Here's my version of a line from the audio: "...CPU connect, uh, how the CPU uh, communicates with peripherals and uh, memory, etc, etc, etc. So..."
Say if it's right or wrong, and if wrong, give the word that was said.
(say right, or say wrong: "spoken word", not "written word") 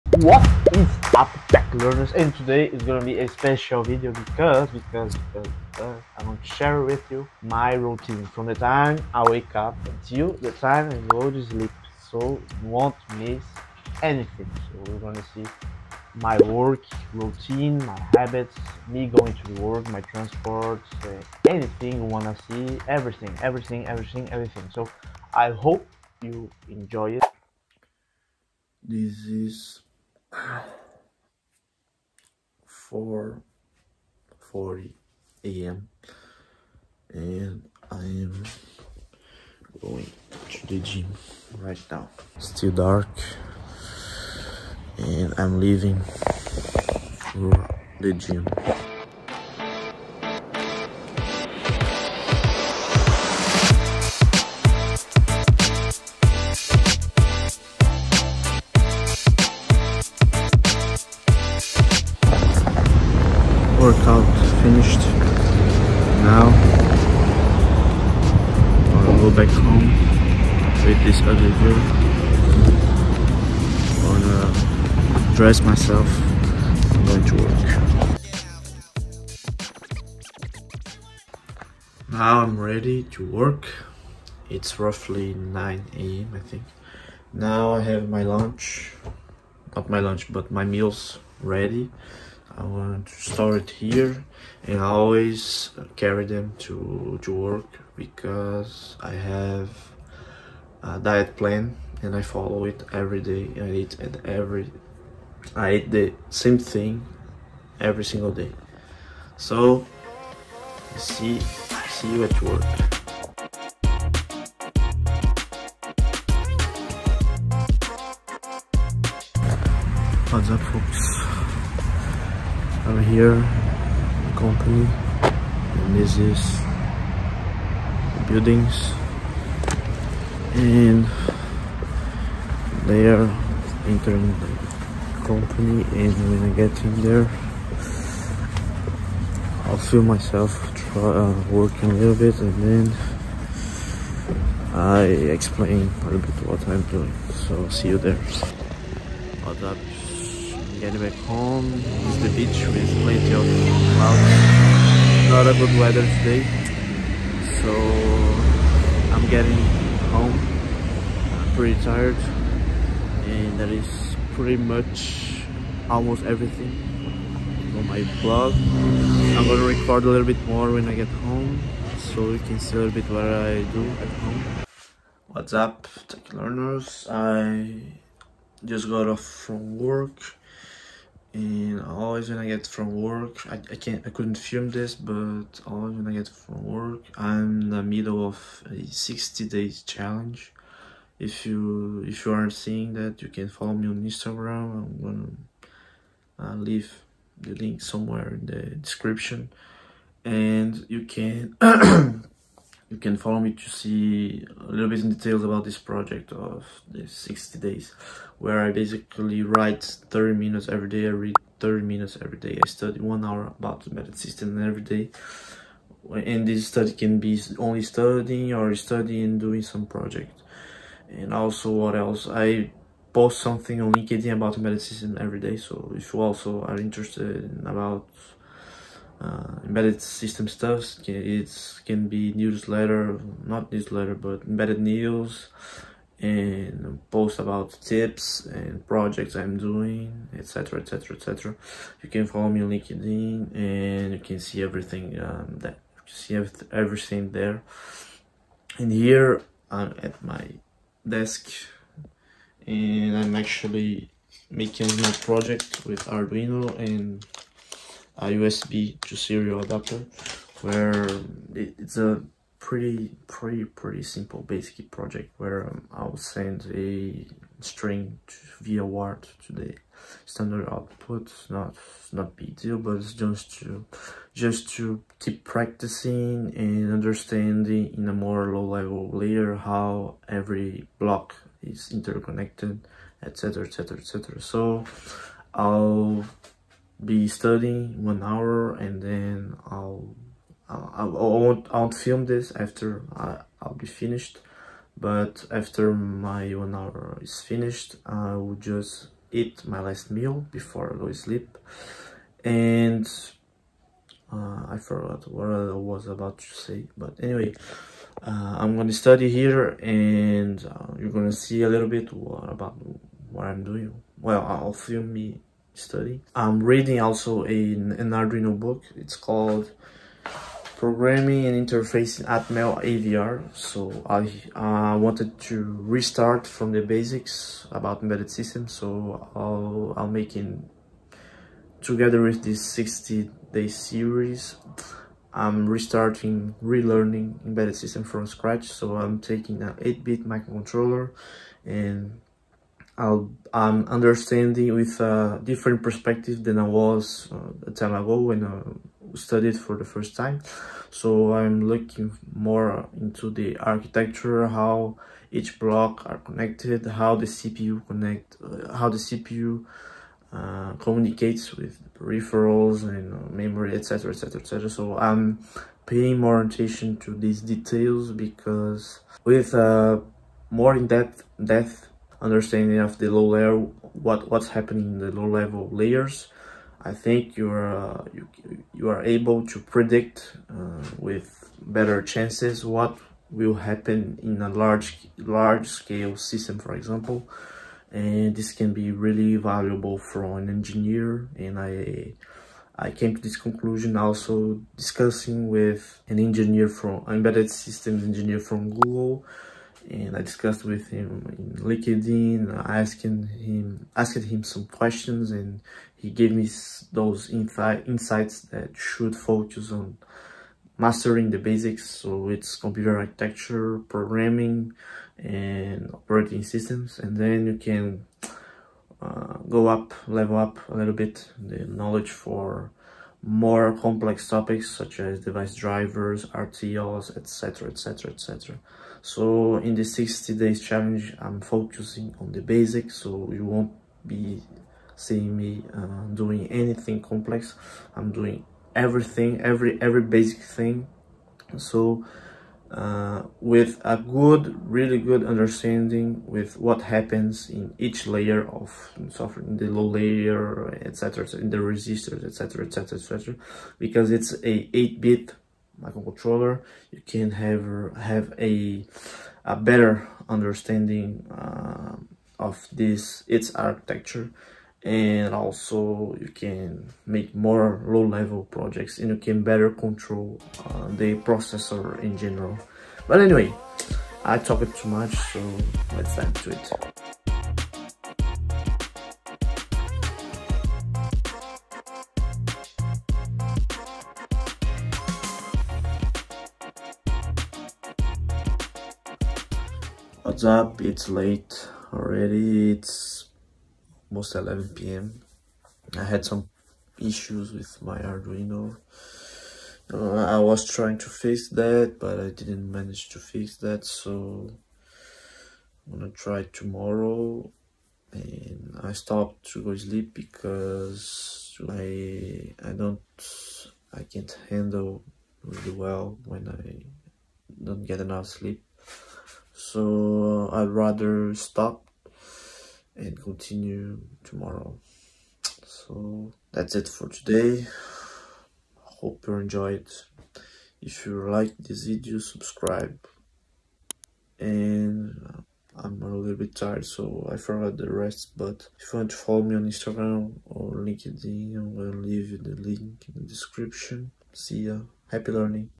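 right.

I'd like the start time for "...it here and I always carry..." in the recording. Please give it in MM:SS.
01:33.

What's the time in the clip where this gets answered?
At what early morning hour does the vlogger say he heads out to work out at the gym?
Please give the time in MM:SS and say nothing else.
00:30.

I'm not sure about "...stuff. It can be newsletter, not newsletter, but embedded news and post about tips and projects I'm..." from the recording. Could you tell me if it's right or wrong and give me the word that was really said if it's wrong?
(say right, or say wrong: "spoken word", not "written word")
right.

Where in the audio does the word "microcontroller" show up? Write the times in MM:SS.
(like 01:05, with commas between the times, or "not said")
05:40, 07:35.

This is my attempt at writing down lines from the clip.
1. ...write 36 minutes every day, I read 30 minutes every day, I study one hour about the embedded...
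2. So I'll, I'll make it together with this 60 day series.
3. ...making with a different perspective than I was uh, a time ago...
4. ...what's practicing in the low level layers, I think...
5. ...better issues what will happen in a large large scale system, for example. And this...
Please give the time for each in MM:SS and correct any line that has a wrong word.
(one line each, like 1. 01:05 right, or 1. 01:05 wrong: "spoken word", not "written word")
1. 03:29 wrong: "30", not "36"
2. 05:28 right
3. 05:43 wrong: "understanding", not "making"
4. 06:14 wrong: "happening", not "practicing"
5. 06:21 wrong: "chances", not "issues".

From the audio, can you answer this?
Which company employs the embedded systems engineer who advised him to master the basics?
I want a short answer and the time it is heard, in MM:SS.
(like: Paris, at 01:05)
Google, at 06:38.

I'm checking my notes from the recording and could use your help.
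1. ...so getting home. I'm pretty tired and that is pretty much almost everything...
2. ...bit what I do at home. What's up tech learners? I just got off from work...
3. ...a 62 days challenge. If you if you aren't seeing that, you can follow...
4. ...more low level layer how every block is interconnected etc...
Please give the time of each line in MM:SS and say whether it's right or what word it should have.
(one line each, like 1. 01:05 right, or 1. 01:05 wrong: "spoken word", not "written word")
1. 02:37 right
2. 02:52 right
3. 03:08 wrong: "60", not "62"
4. 04:38 right.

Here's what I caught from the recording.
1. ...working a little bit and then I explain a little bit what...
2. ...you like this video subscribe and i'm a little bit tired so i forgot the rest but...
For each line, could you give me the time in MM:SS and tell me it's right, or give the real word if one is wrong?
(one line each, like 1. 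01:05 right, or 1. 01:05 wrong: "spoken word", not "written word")
1. 02:21 right
2. 08:51 right.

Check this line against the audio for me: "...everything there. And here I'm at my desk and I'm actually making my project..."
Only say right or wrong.
right.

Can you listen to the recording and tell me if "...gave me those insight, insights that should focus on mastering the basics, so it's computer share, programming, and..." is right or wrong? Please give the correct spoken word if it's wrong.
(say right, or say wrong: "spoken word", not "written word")
wrong: "architecture", not "share".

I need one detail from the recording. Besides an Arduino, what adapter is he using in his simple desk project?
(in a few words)
USB to serial adapter.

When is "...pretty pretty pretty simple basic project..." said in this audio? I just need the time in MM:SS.
04:22.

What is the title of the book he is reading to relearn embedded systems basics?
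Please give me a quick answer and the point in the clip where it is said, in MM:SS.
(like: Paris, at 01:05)
Programming and Interfacing Atmel AVR, at 05:20.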